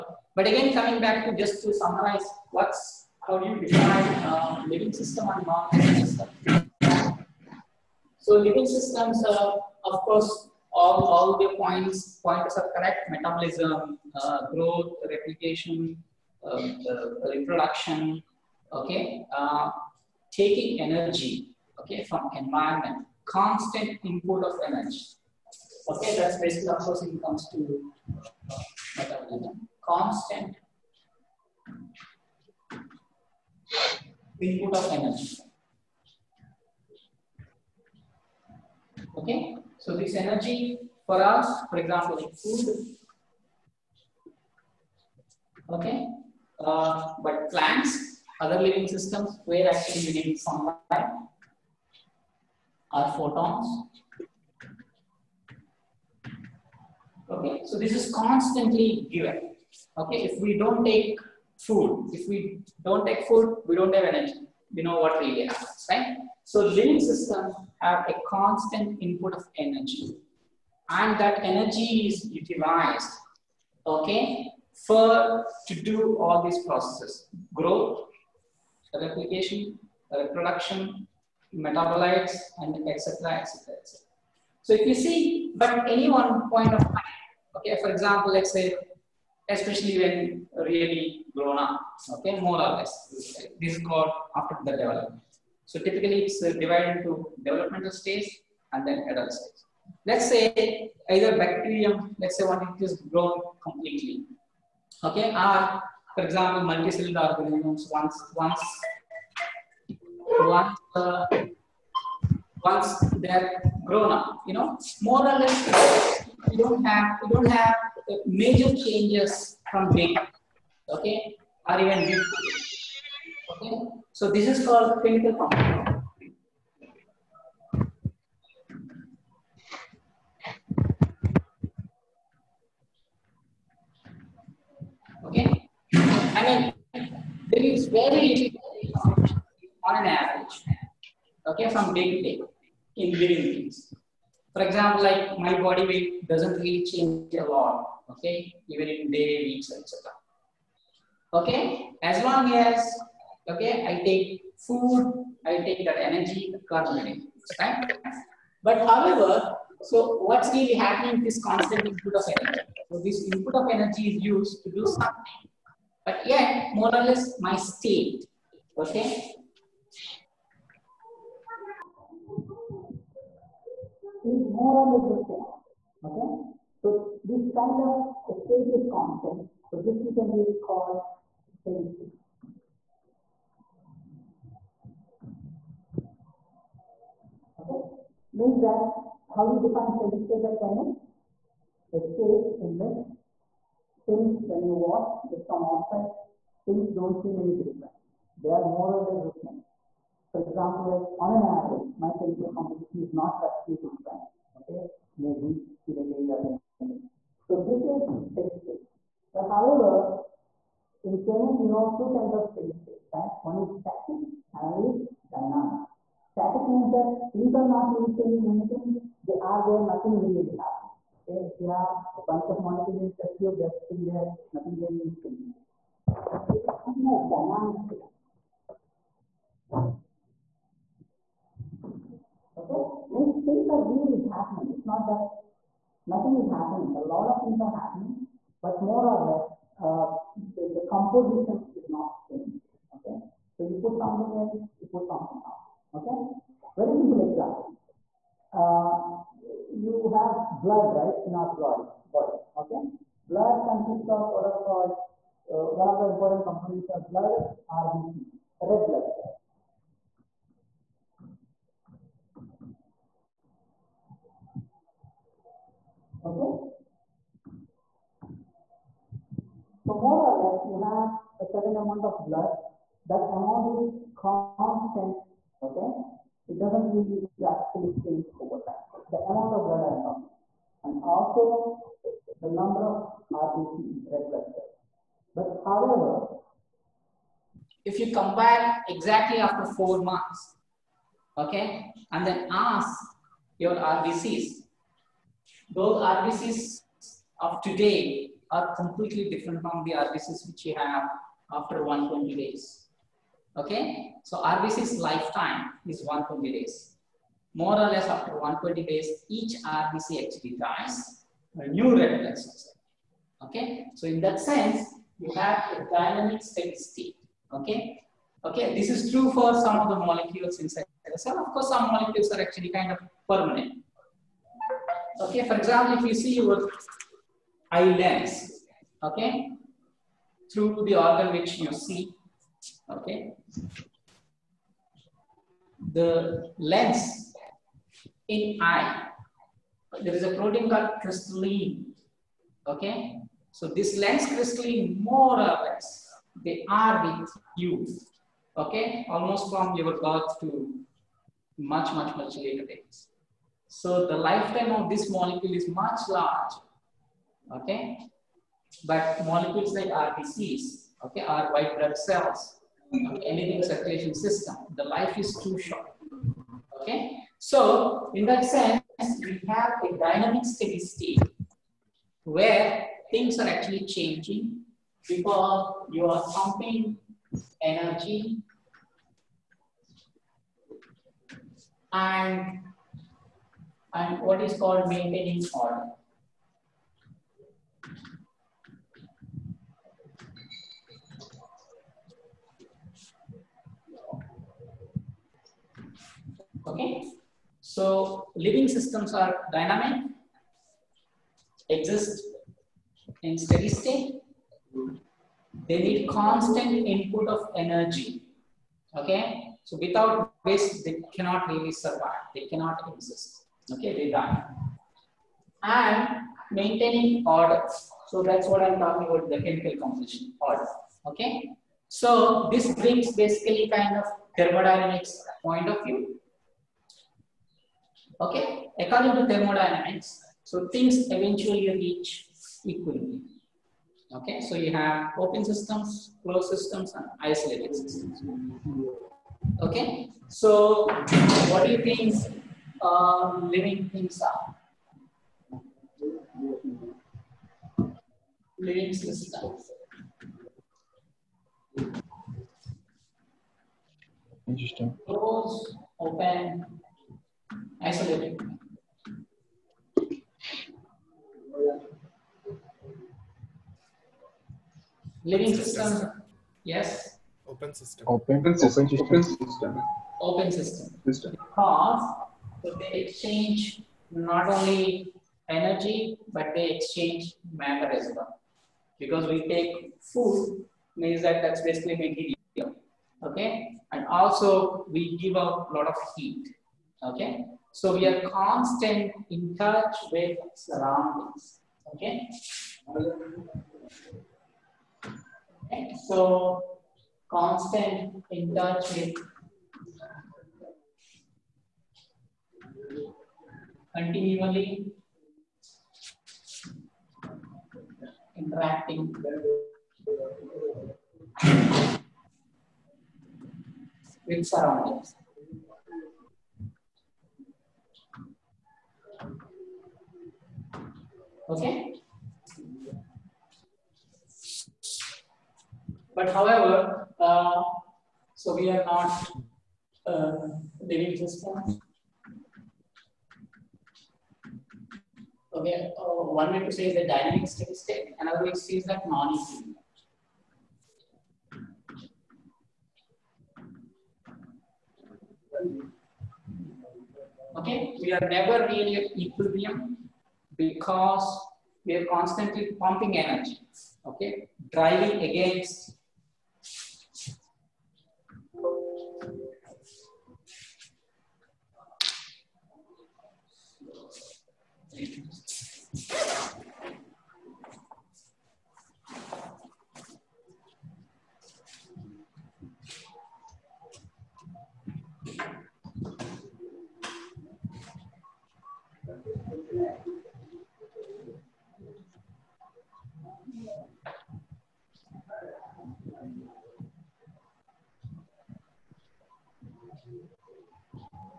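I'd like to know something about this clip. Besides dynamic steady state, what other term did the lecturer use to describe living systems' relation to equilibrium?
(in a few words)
non-equilibrium.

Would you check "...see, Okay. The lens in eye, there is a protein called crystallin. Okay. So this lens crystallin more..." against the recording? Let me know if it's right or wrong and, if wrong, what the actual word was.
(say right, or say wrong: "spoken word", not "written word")
right.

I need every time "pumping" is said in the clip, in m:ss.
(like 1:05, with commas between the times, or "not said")
6:16, 9:12.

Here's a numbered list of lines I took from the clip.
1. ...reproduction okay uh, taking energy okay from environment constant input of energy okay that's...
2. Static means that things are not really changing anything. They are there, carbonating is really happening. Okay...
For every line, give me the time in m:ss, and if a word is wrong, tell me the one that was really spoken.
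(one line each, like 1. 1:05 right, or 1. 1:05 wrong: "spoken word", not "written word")
1. 0:17 right
2. 3:36 wrong: "nothing", not "carbonating".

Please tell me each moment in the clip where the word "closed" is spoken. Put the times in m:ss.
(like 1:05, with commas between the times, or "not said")
7:16, 7:35.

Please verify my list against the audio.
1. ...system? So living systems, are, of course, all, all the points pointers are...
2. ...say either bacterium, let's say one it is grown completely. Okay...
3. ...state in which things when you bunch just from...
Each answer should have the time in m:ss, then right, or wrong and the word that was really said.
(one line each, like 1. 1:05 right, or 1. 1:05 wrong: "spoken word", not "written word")
1. 0:06 right
2. 1:40 right
3. 3:11 wrong: "watch", not "bunch".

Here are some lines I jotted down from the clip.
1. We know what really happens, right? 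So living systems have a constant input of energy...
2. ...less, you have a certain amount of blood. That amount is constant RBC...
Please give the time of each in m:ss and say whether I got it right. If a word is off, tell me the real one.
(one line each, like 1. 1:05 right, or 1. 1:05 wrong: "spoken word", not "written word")
1. 1:04 right
2. 4:30 wrong: "Okay", not "RBC".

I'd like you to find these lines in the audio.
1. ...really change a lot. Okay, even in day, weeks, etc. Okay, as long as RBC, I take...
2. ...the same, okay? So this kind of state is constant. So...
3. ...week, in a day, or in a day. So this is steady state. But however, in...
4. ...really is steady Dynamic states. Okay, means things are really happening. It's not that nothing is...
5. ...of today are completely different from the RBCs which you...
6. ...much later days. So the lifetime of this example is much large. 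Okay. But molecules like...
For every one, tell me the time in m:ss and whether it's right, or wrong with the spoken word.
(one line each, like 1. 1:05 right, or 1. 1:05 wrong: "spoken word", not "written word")
1. 2:26 wrong: "Okay", not "RBC"
2. 2:55 right
3. 3:25 right
4. 3:44 right
5. 4:57 right
6. 5:52 wrong: "molecule", not "example".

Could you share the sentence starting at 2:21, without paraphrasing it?
Okay, from day to day in living things.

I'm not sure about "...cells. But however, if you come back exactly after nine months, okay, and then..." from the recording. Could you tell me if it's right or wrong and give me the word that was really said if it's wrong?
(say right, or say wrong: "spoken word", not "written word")
wrong: "four", not "nine".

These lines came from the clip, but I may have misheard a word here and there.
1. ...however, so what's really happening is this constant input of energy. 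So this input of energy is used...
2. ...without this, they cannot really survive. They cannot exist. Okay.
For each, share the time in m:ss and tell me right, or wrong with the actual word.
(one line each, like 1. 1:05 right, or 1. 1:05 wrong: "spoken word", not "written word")
1. 2:38 right
2. 6:49 right.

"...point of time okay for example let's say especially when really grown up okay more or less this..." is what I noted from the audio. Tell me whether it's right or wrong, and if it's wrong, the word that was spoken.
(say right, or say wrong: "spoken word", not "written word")
right.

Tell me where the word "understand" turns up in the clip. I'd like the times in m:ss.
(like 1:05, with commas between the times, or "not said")
not said.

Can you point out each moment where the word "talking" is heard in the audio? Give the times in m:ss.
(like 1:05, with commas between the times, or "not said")
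4:40, 6:58.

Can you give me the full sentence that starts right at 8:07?
Okay, so we are constant in touch with surroundings.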